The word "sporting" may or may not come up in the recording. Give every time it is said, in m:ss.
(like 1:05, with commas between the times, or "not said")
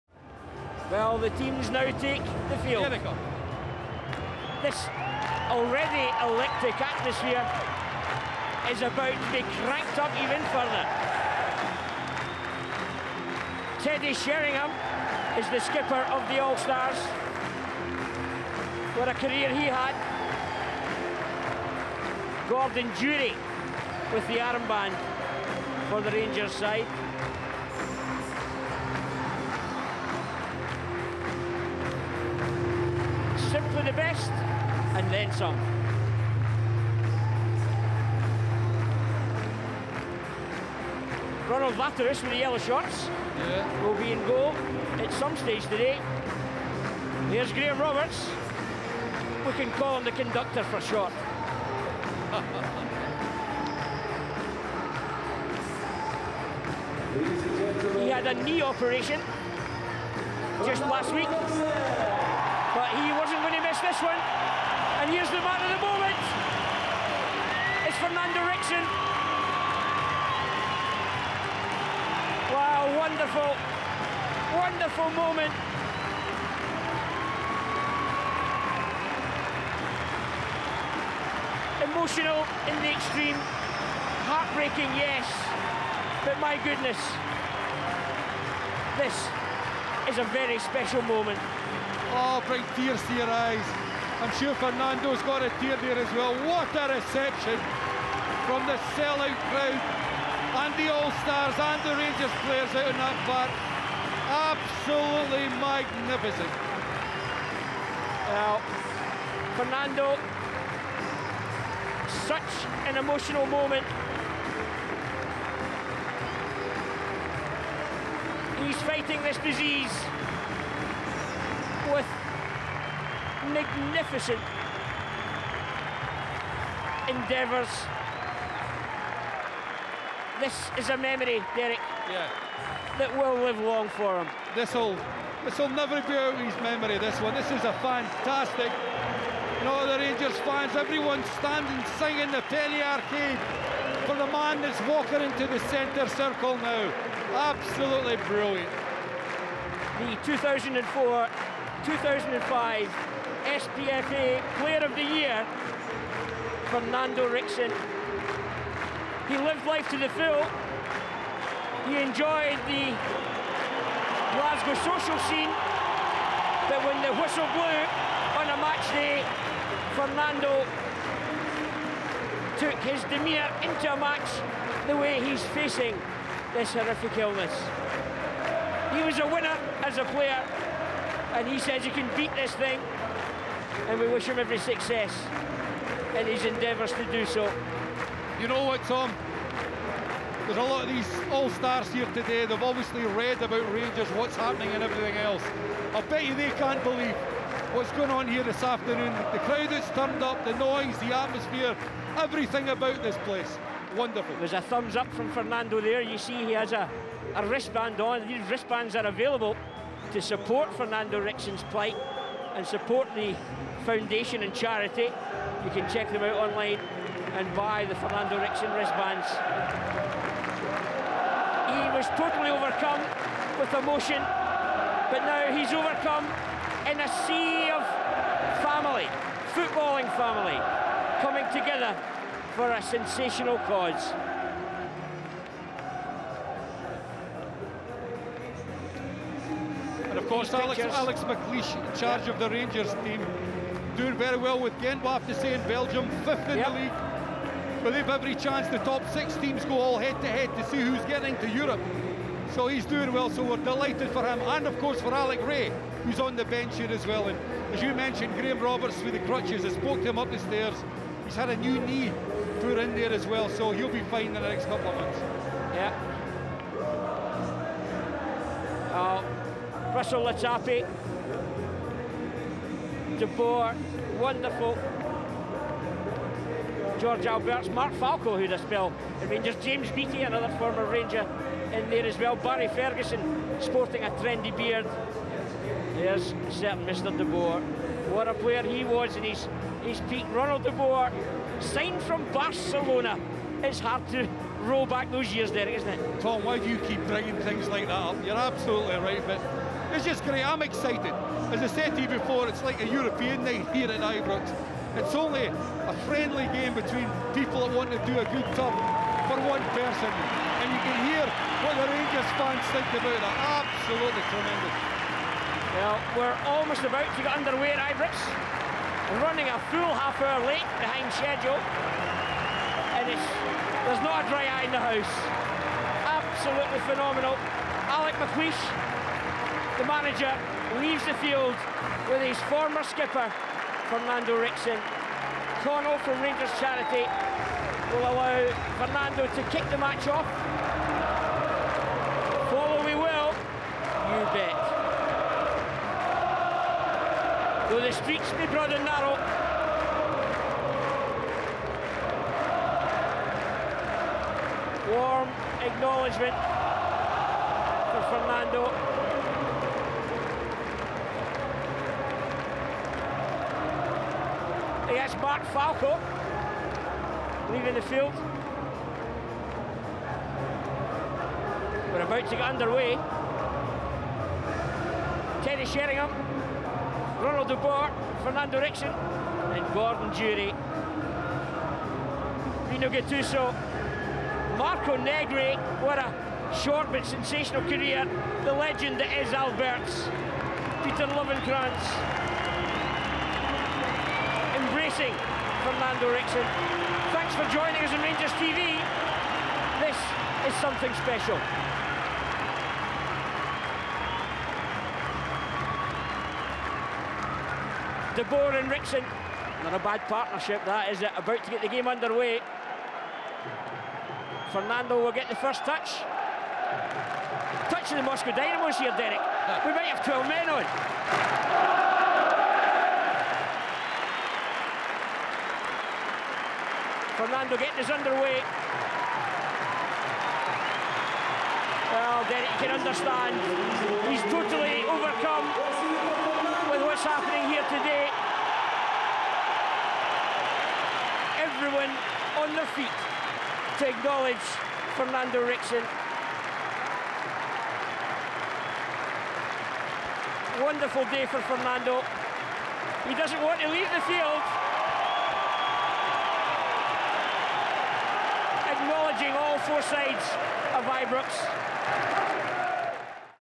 4:43.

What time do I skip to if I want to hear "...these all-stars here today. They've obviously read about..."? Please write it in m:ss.
3:10.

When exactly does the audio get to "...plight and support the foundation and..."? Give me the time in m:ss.
3:31.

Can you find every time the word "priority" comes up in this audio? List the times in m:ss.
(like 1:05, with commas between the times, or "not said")
not said.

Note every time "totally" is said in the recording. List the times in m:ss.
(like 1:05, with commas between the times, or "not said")
3:42, 7:14.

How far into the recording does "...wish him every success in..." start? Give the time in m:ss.
3:04.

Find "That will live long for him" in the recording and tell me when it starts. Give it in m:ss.
2:12.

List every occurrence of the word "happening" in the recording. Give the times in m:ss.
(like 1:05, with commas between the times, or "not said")
3:14, 7:17.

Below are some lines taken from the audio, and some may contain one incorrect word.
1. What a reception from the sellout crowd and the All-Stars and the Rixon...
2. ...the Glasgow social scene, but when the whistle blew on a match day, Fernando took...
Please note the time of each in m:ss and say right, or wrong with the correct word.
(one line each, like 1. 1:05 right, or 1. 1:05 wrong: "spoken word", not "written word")
1. 1:36 wrong: "Rangers", not "Rixon"
2. 2:42 right.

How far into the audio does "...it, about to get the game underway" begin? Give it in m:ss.
6:51.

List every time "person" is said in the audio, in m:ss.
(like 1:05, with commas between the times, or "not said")
5:09.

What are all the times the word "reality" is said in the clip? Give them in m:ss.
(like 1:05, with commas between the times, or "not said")
not said.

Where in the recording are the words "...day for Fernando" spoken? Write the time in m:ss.
7:31.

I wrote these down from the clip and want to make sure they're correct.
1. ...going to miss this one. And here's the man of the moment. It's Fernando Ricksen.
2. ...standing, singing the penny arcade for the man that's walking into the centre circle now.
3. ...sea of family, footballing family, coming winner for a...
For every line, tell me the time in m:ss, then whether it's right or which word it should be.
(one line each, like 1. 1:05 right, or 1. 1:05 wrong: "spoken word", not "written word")
1. 1:03 right
2. 2:21 right
3. 3:47 wrong: "together", not "winner".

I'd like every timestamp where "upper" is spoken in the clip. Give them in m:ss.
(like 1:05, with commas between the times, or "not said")
not said.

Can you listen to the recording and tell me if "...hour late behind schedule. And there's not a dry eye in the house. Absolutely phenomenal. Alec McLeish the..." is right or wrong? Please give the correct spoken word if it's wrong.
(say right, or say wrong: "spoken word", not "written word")
right.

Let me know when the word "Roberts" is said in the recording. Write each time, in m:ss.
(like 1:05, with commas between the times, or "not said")
0:47, 4:18.